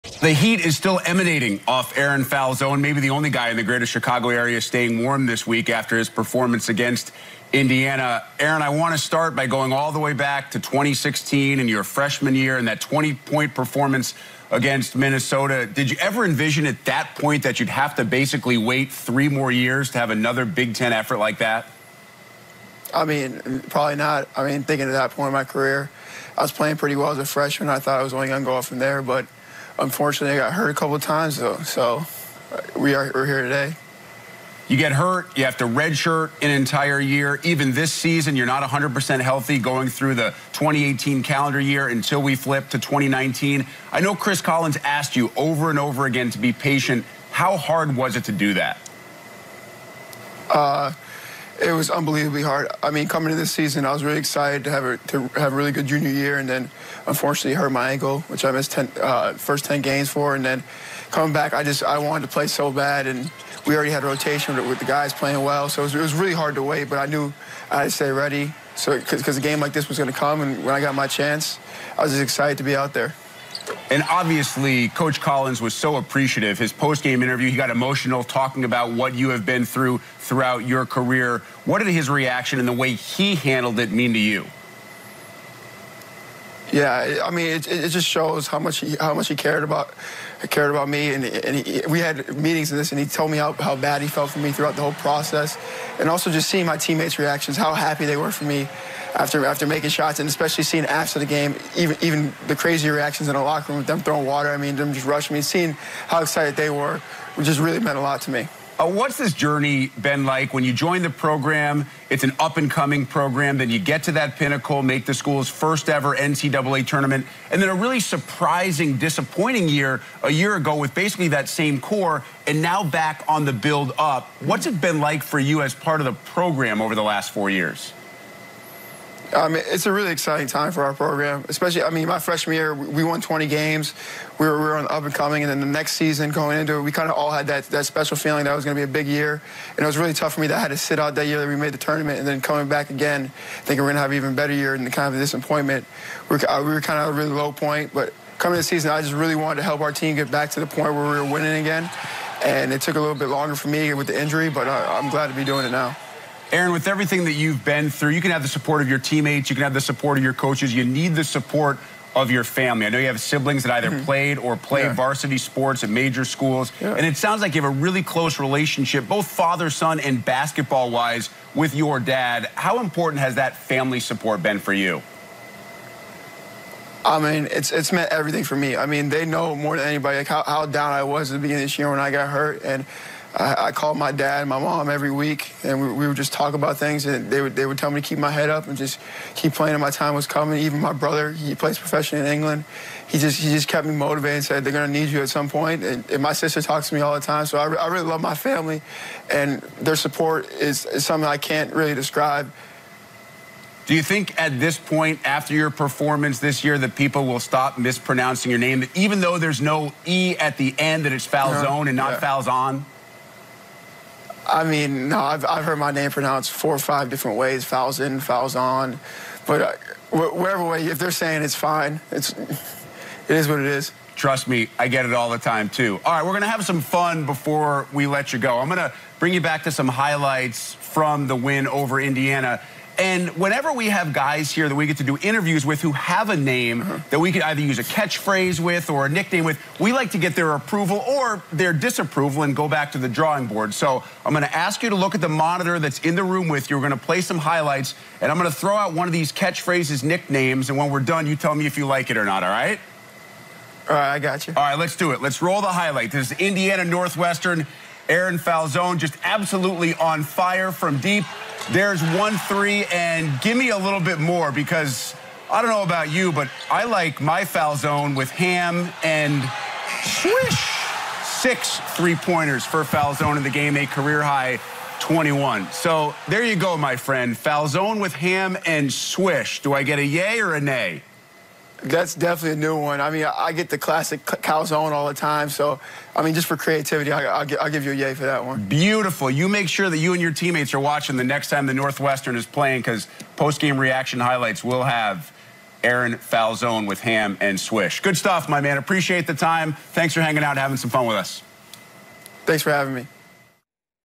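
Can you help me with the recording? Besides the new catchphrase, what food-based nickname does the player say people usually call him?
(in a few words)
calzone.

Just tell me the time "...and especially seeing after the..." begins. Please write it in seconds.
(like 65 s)
100 s.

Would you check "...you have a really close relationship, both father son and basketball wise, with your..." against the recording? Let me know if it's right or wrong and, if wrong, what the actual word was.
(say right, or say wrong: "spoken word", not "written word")
right.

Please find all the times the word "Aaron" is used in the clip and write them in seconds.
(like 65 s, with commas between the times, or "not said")
1 s, 8 s, 156 s, 258 s, 295 s.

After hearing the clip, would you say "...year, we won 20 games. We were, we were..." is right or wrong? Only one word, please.
right.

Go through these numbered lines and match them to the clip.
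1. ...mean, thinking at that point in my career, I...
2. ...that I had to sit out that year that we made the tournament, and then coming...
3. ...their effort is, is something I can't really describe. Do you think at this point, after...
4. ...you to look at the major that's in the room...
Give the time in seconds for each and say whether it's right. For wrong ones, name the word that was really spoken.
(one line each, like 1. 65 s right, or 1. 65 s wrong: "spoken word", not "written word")
1. 24 s right
2. 140 s right
3. 199 s wrong: "support", not "effort"
4. 244 s wrong: "monitor", not "major".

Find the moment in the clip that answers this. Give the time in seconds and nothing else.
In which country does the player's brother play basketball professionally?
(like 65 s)
192 s.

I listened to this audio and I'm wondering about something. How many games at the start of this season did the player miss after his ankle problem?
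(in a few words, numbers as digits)
10.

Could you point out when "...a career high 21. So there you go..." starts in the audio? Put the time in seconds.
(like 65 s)
273 s.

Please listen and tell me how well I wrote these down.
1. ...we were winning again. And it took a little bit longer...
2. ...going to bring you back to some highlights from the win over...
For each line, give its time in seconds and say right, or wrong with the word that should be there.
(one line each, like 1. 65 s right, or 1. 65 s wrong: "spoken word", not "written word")
1. 151 s right
2. 228 s right.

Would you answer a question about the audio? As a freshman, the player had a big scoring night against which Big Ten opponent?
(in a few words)
Minnesota.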